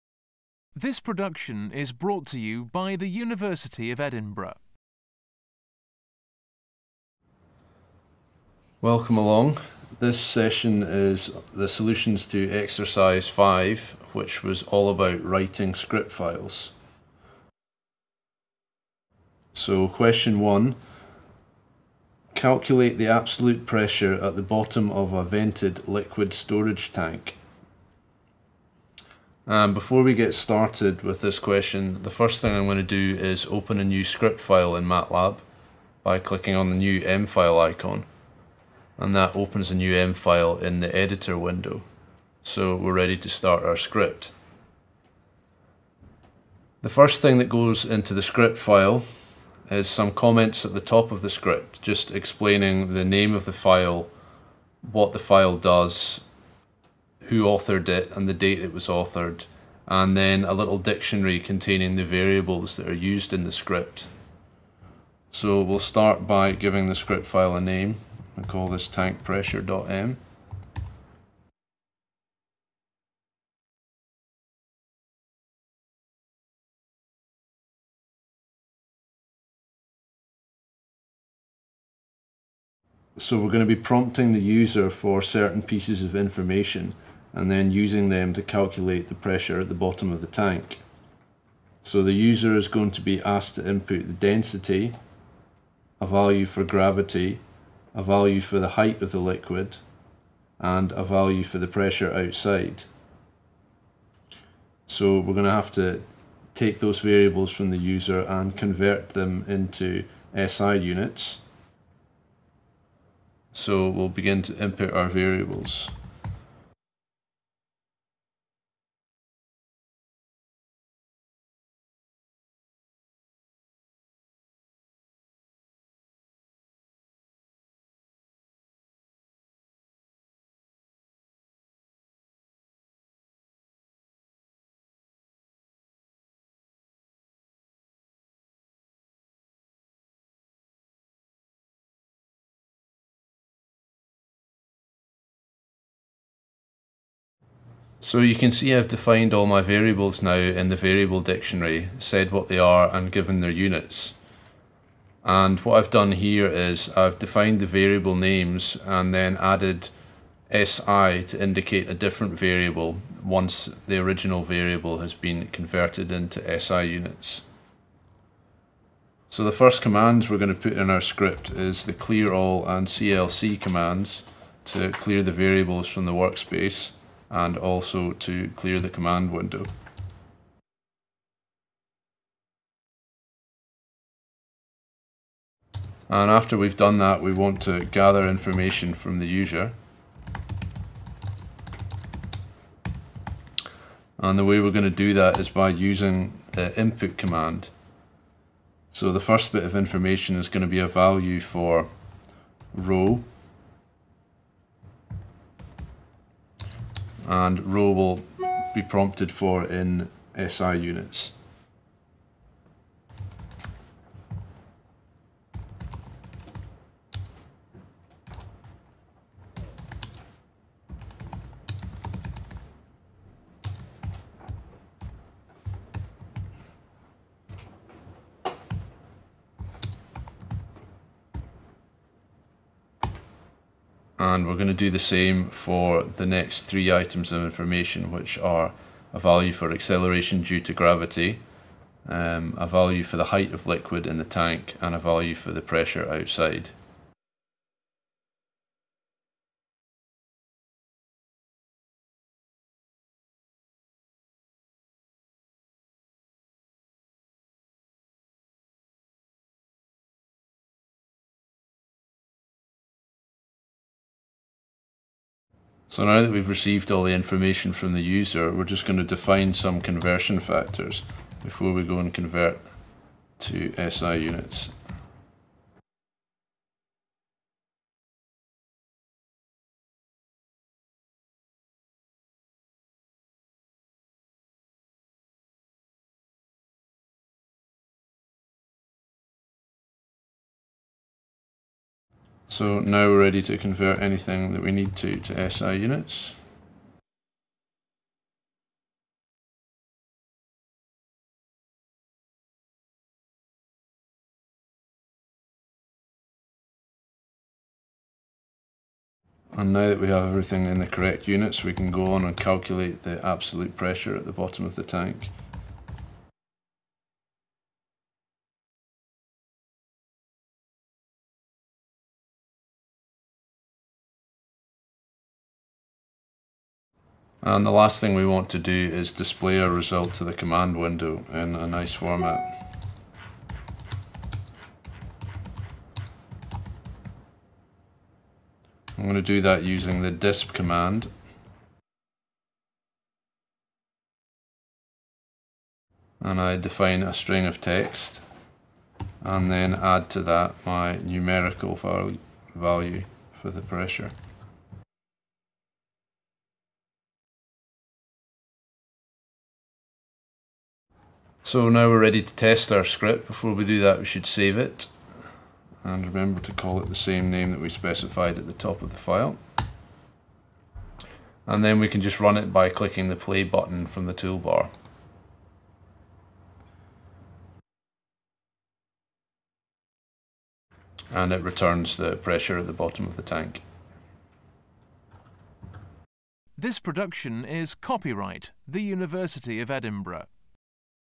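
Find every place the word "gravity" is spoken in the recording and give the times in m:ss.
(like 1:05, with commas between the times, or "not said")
1:36, 4:00.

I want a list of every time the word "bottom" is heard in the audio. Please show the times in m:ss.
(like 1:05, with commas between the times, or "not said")
0:24, 1:29, 5:14, 6:22.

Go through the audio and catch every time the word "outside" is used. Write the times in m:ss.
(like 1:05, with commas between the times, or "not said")
1:42, 4:06.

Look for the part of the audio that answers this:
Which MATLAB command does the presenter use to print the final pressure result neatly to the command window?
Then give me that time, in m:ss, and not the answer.
5:40.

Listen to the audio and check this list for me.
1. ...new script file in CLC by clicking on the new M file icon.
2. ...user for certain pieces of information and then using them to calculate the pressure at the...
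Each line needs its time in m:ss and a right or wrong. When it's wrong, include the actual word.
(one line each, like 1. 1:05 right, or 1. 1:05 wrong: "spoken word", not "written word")
1. 0:33 wrong: "MATLAB", not "CLC"
2. 1:24 right.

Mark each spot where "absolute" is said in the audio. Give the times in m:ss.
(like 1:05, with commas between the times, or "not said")
0:23, 5:13.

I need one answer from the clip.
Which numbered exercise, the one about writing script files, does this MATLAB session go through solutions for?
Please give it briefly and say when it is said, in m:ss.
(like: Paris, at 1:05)
5, at 0:12.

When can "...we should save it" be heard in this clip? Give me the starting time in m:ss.
6:03.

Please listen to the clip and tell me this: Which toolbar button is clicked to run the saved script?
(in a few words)
play button.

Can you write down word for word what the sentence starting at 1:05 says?
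So we'll start by giving the script file a name.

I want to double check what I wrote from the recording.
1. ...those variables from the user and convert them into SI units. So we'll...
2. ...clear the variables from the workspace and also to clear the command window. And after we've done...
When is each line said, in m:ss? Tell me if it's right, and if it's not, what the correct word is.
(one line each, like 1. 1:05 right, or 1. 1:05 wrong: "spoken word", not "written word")
1. 1:46 right
2. 2:54 right.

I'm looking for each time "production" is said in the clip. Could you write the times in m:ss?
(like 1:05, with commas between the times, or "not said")
0:01, 6:26.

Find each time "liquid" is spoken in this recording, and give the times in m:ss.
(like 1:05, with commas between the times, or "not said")
0:25, 1:39, 4:03.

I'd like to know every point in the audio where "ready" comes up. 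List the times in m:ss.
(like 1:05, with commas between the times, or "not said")
0:42, 4:53, 6:01.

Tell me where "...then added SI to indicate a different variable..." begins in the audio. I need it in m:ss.
2:39.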